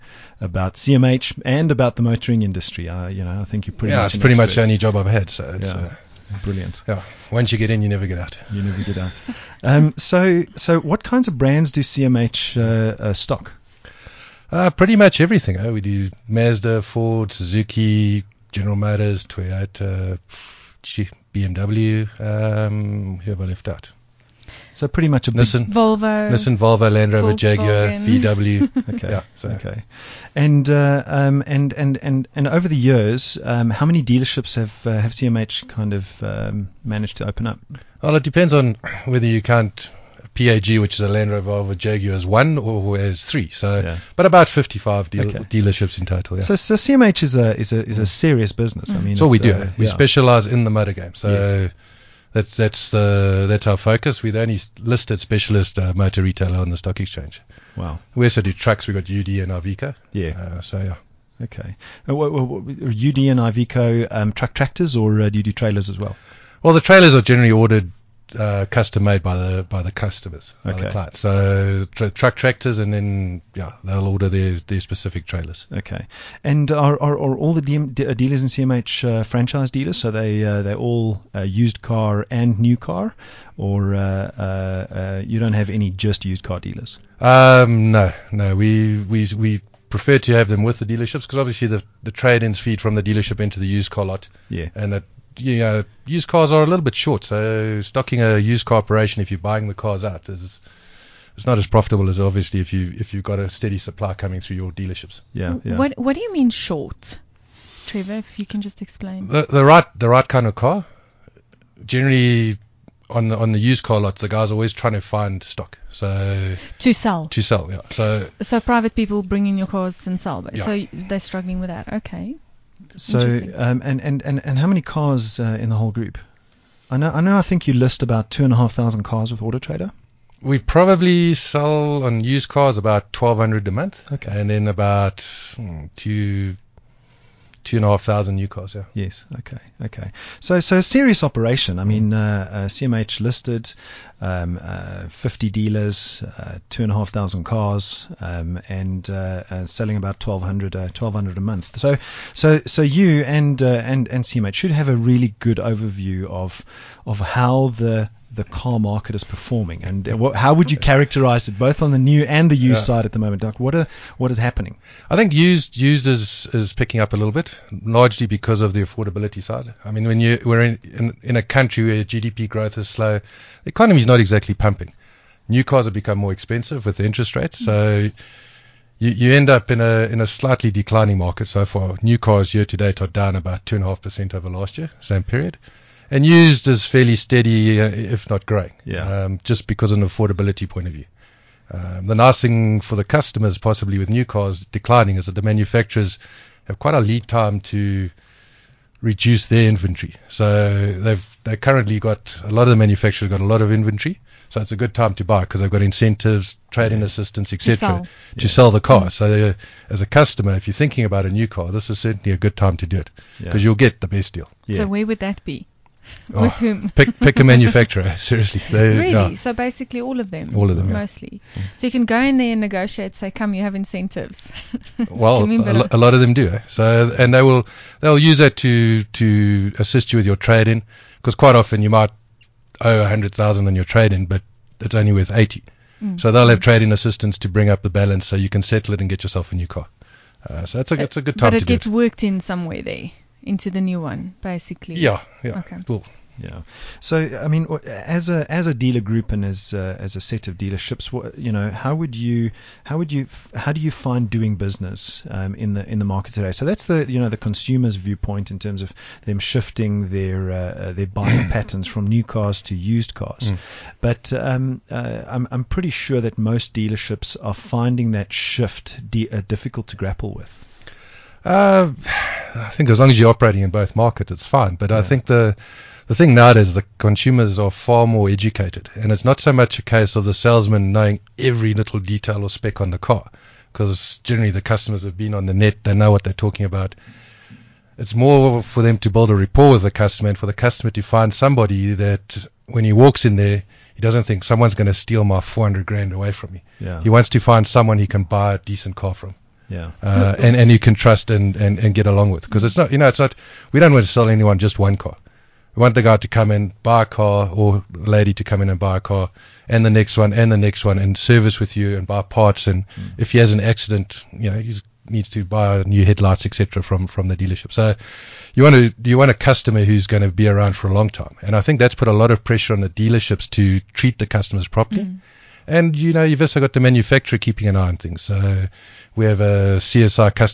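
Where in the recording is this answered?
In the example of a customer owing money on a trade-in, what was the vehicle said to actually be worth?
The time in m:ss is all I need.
3:55.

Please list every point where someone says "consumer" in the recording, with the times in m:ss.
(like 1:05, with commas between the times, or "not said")
4:17, 4:36.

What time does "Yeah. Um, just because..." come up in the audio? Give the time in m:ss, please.
3:08.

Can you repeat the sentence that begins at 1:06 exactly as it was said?
Well, the trailers are generally ordered uh, custom made by the by the customers, by okay.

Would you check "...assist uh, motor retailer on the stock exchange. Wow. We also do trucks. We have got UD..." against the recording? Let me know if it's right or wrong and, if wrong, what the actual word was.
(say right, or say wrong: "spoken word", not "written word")
wrong: "specialist", not "assist".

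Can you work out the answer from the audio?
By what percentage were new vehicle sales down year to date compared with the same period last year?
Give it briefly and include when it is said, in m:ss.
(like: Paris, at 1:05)
2.5 percent, at 3:03.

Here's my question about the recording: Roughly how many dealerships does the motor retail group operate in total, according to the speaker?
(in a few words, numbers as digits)
55.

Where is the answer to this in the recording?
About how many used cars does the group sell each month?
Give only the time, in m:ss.
2:12.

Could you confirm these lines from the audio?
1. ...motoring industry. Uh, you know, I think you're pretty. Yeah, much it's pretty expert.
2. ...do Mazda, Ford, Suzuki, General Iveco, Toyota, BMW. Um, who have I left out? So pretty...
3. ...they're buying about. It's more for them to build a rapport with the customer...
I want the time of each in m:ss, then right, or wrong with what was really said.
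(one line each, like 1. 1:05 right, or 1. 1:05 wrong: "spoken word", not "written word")
1. 0:02 right
2. 0:15 wrong: "Motors", not "Iveco"
3. 4:46 wrong: "talking", not "buying".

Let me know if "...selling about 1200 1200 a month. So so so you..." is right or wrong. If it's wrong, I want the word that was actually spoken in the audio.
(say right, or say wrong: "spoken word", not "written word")
right.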